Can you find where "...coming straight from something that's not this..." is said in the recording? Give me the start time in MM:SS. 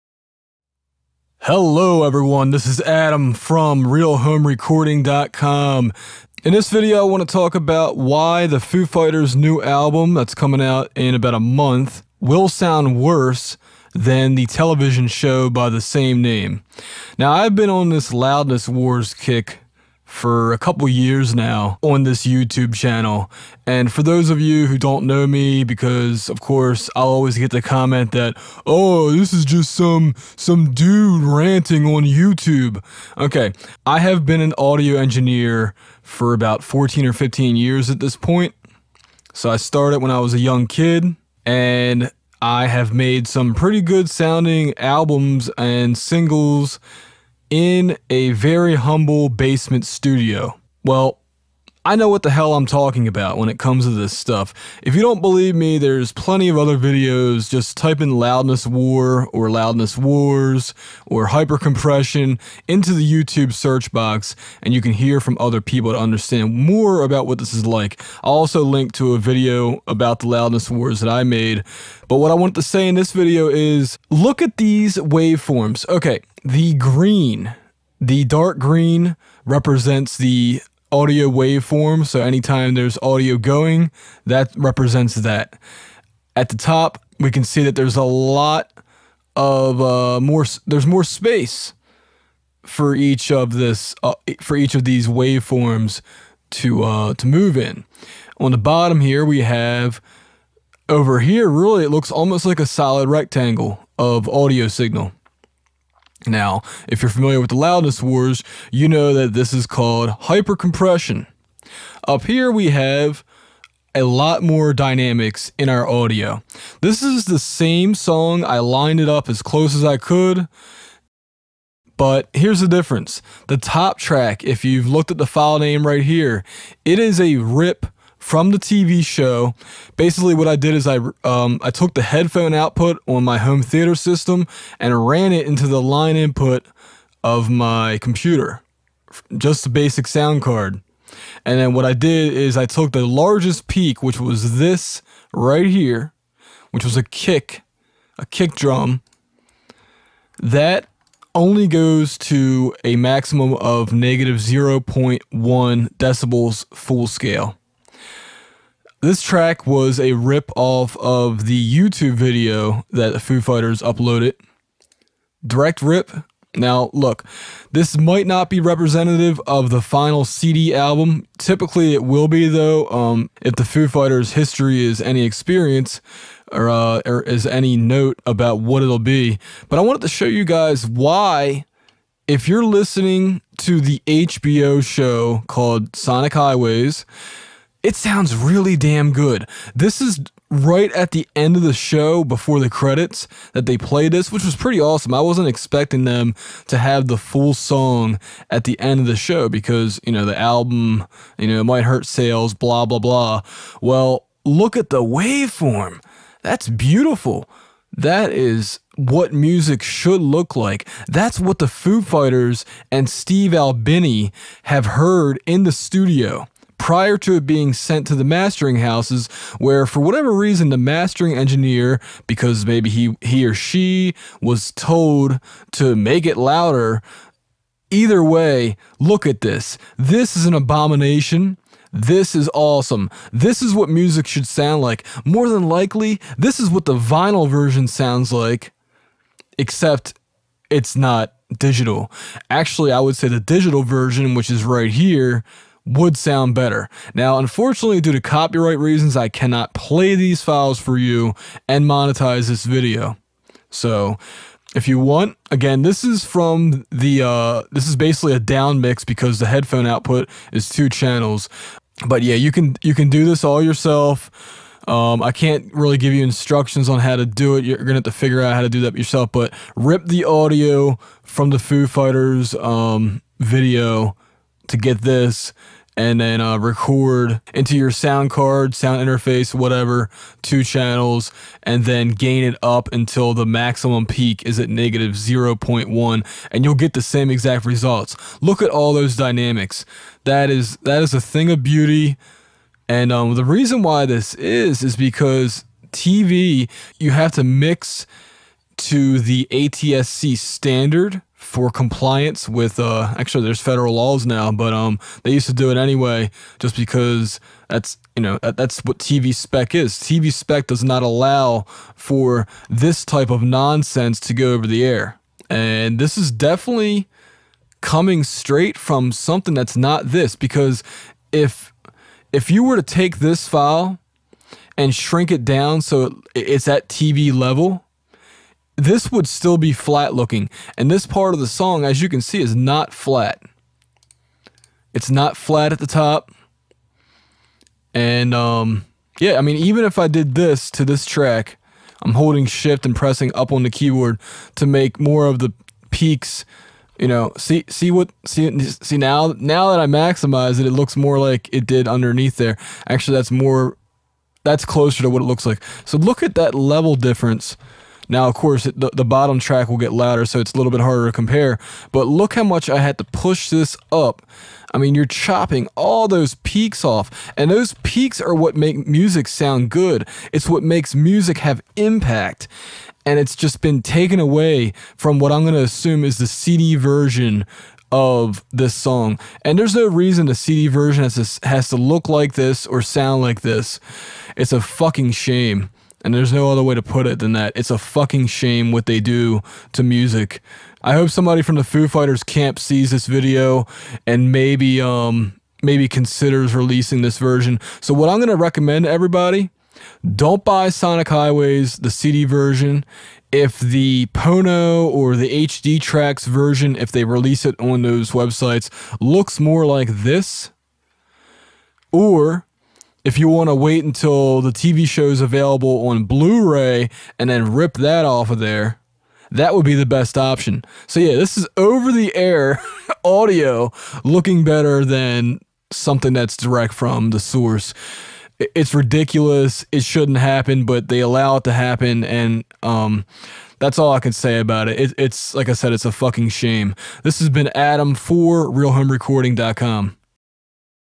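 05:17.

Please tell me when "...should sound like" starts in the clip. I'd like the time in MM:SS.
03:54.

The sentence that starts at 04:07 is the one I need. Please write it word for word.
Now, unfortunately, due to copyright reasons, I cannot play these files for you and monetize this video.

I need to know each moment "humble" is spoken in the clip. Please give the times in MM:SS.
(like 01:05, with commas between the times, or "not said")
00:48.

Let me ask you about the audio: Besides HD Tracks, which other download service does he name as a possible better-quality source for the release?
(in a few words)
Pono.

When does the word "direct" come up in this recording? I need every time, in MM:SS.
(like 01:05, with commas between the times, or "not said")
02:45, 07:06.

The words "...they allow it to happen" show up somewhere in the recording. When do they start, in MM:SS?
07:10.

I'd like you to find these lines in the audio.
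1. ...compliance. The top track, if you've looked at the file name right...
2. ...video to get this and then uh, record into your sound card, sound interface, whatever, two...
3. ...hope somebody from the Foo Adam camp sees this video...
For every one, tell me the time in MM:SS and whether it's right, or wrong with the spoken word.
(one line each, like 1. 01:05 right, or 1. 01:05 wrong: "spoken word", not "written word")
1. 02:02 wrong: "difference", not "compliance"
2. 04:33 right
3. 06:30 wrong: "Fighters", not "Adam".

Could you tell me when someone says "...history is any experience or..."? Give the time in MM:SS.
02:54.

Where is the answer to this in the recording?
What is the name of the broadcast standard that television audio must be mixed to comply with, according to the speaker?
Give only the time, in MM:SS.
04:59.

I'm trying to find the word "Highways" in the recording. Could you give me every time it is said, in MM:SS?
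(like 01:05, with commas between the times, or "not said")
03:06, 06:41.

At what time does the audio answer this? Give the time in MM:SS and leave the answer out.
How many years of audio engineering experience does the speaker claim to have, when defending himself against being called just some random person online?
00:36.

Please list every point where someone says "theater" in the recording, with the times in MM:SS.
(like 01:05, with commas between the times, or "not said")
02:13.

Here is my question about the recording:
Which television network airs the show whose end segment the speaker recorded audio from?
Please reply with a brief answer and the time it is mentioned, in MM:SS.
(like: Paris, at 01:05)
HBO, at 03:04.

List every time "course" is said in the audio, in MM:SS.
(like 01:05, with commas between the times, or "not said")
00:26, 05:58.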